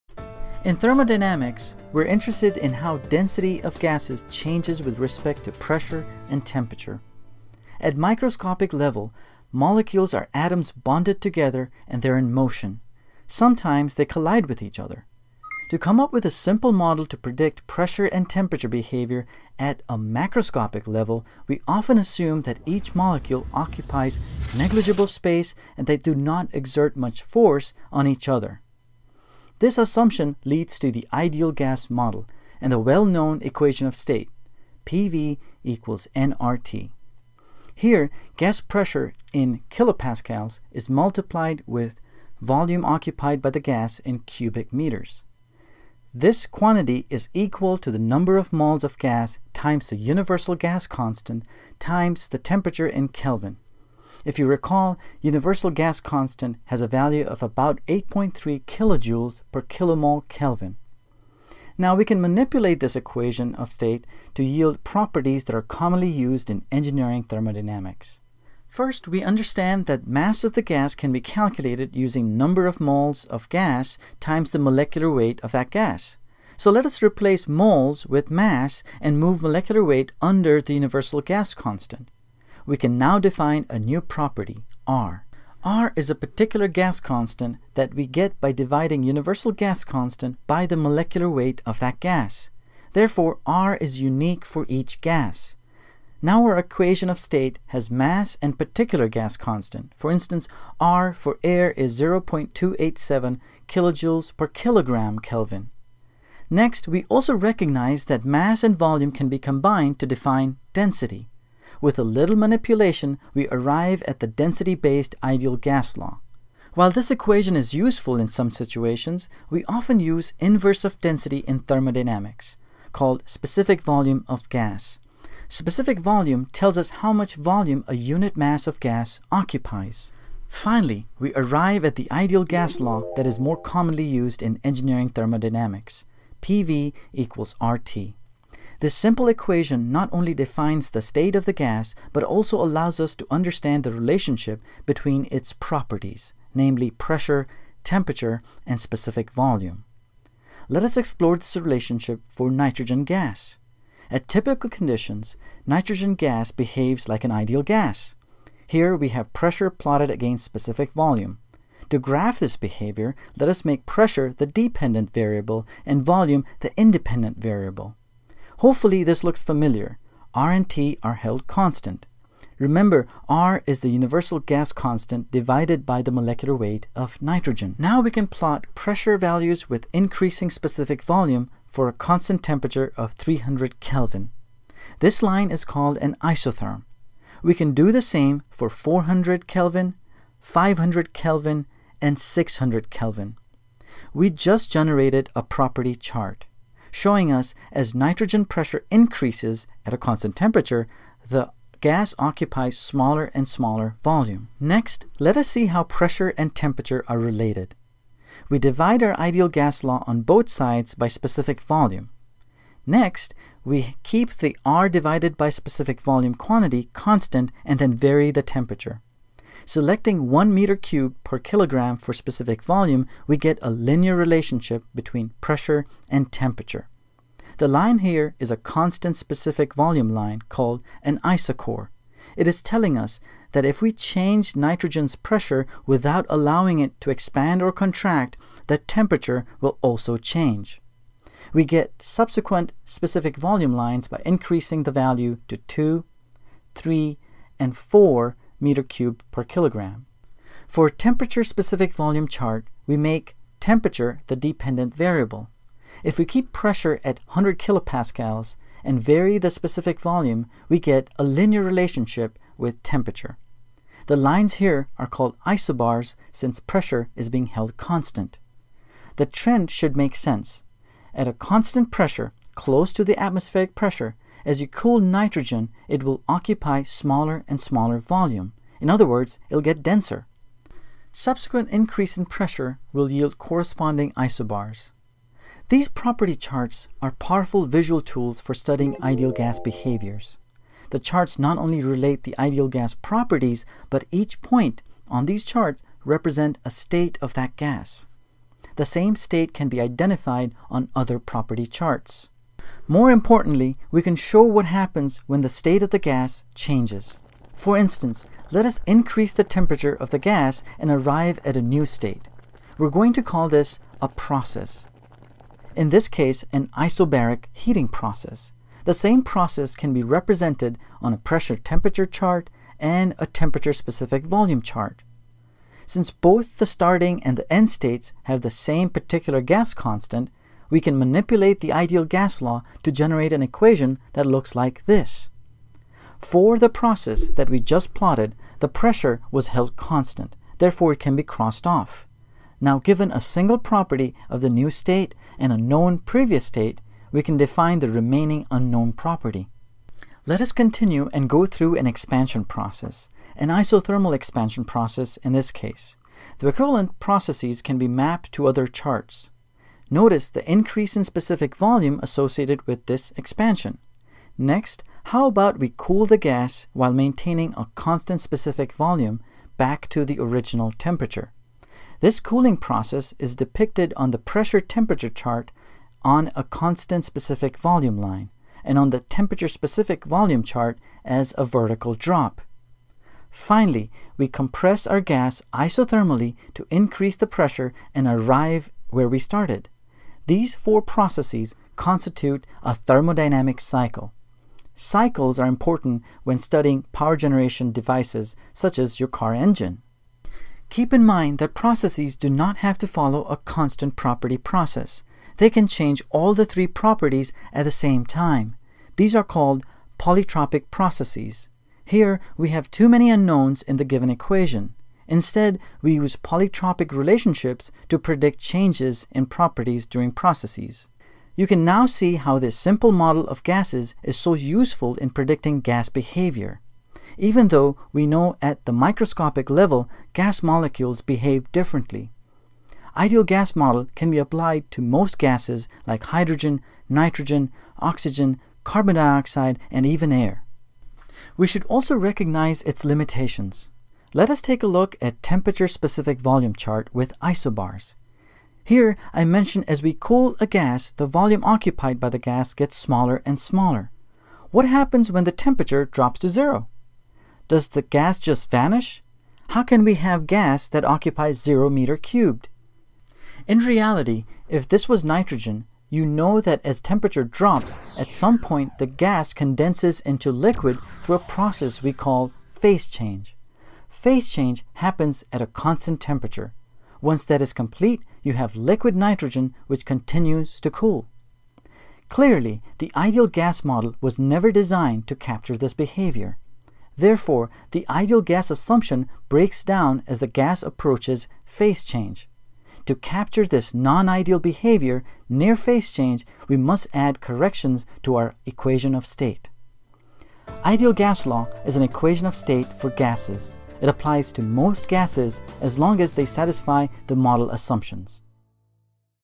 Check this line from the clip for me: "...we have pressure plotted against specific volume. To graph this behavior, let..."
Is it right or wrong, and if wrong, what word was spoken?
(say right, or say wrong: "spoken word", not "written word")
right.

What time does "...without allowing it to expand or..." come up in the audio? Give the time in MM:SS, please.
03:55.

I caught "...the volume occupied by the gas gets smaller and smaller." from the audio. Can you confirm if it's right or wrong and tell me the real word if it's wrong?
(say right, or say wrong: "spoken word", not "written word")
right.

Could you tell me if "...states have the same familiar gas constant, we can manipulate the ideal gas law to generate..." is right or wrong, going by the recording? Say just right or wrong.
wrong.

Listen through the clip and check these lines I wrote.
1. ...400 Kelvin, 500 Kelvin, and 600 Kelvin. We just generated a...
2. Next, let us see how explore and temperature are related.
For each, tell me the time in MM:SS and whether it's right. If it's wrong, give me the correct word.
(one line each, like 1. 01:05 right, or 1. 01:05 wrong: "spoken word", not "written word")
1. 03:08 right
2. 03:24 wrong: "pressure", not "explore".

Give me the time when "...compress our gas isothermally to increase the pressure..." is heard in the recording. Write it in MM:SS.
06:24.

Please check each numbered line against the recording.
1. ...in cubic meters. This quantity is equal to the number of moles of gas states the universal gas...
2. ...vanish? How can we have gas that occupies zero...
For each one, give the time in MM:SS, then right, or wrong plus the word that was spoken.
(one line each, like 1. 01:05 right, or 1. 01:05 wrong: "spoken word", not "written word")
1. 00:43 wrong: "times", not "states"
2. 07:38 right.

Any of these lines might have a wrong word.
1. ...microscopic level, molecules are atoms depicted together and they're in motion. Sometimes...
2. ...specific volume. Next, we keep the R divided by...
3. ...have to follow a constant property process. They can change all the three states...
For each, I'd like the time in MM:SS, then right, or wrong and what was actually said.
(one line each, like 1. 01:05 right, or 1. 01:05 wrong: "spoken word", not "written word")
1. 00:07 wrong: "bonded", not "depicted"
2. 03:31 right
3. 06:42 wrong: "properties", not "states".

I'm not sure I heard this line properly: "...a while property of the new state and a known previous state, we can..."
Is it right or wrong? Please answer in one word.
wrong.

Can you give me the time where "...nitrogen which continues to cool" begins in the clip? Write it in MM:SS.
07:58.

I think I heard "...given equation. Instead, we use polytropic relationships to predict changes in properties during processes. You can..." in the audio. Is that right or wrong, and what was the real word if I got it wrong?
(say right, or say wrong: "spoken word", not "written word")
right.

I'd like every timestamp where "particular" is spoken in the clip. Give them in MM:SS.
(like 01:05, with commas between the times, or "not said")
01:26, 01:38, 05:28.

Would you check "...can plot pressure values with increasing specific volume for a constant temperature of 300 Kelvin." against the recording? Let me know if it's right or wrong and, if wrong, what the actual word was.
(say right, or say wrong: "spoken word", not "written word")
right.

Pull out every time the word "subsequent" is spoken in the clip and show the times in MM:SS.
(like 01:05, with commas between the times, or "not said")
04:02, 04:41.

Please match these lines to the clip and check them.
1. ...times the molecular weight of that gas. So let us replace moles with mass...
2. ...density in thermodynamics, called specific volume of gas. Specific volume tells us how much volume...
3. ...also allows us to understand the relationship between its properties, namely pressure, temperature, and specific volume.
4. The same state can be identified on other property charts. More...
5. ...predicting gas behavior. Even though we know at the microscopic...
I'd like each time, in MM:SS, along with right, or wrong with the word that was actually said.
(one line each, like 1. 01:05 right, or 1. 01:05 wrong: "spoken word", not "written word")
1. 01:14 right
2. 02:01 right
3. 02:22 right
4. 04:58 right
5. 07:05 right.